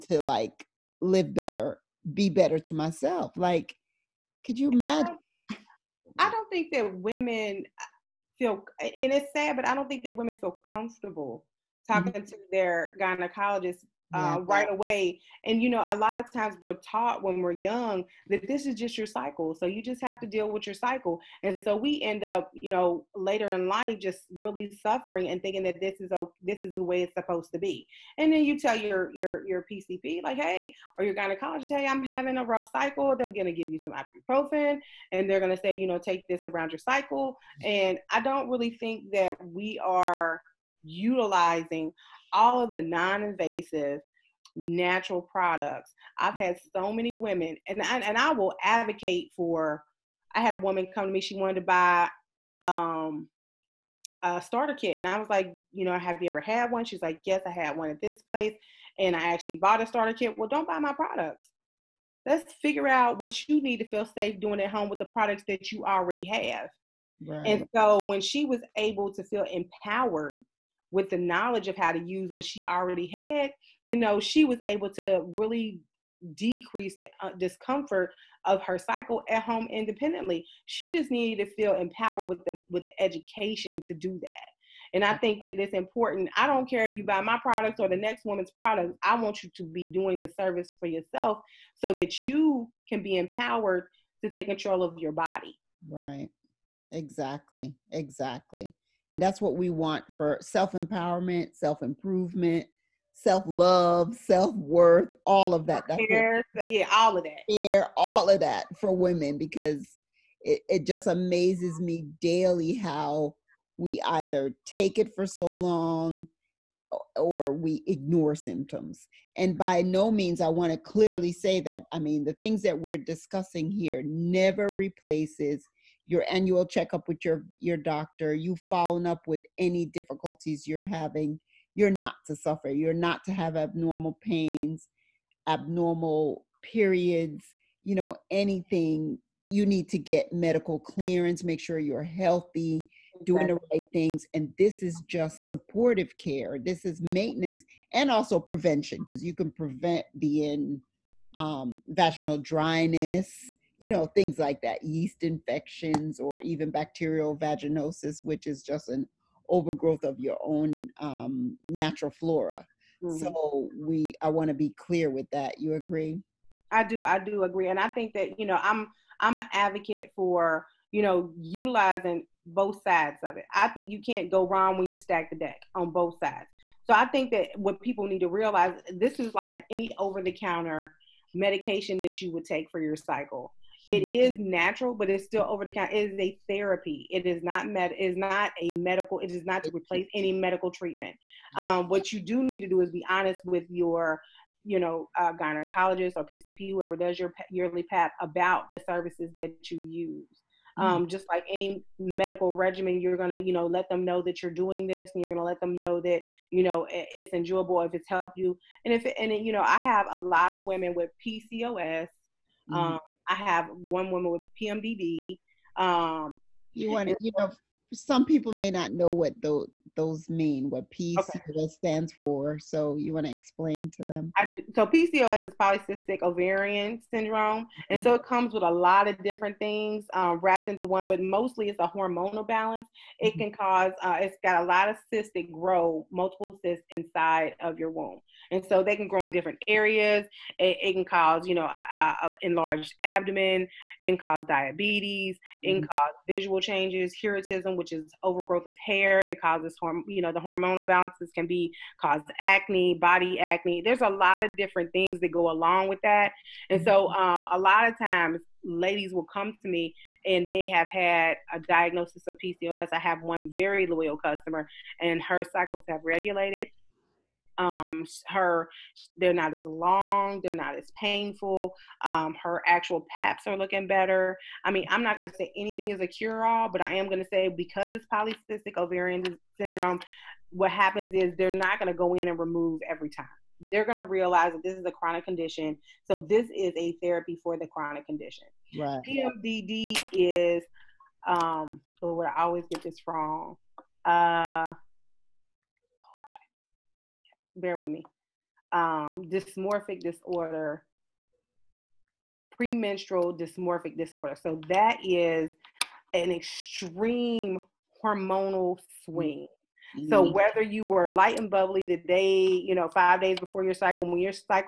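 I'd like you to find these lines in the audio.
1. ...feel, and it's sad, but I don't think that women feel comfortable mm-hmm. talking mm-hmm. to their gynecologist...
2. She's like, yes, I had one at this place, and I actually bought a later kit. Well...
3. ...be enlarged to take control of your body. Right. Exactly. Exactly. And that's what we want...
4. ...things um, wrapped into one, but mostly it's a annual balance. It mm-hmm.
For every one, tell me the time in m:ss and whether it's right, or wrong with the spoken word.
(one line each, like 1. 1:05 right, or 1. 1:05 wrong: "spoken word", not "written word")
1. 0:08 right
2. 0:56 wrong: "starter", not "later"
3. 1:33 wrong: "empowered", not "enlarged"
4. 3:49 wrong: "hormonal", not "annual".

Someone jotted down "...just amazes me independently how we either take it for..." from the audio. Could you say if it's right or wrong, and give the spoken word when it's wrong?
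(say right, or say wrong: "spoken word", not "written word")
wrong: "daily", not "independently".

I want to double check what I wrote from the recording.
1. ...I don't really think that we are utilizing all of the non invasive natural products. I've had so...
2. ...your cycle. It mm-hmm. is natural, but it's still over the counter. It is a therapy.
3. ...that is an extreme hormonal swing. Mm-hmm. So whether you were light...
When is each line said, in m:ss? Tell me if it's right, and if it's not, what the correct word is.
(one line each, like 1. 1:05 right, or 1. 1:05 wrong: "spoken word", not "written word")
1. 0:38 right
2. 3:02 right
3. 5:04 right.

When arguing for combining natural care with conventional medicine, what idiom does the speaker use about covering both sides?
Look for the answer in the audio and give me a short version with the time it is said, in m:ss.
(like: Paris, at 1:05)
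stack the deck, at 2:54.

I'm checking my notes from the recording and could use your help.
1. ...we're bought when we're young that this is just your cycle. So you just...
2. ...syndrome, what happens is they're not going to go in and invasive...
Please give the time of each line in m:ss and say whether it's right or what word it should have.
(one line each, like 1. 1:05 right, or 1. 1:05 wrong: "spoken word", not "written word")
1. 0:16 wrong: "taught", not "bought"
2. 4:39 wrong: "remove", not "invasive".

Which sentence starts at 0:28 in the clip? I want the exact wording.
And then you tell your your your PCP like, hey, or your gynecologist, hey, I'm having a rough cycle.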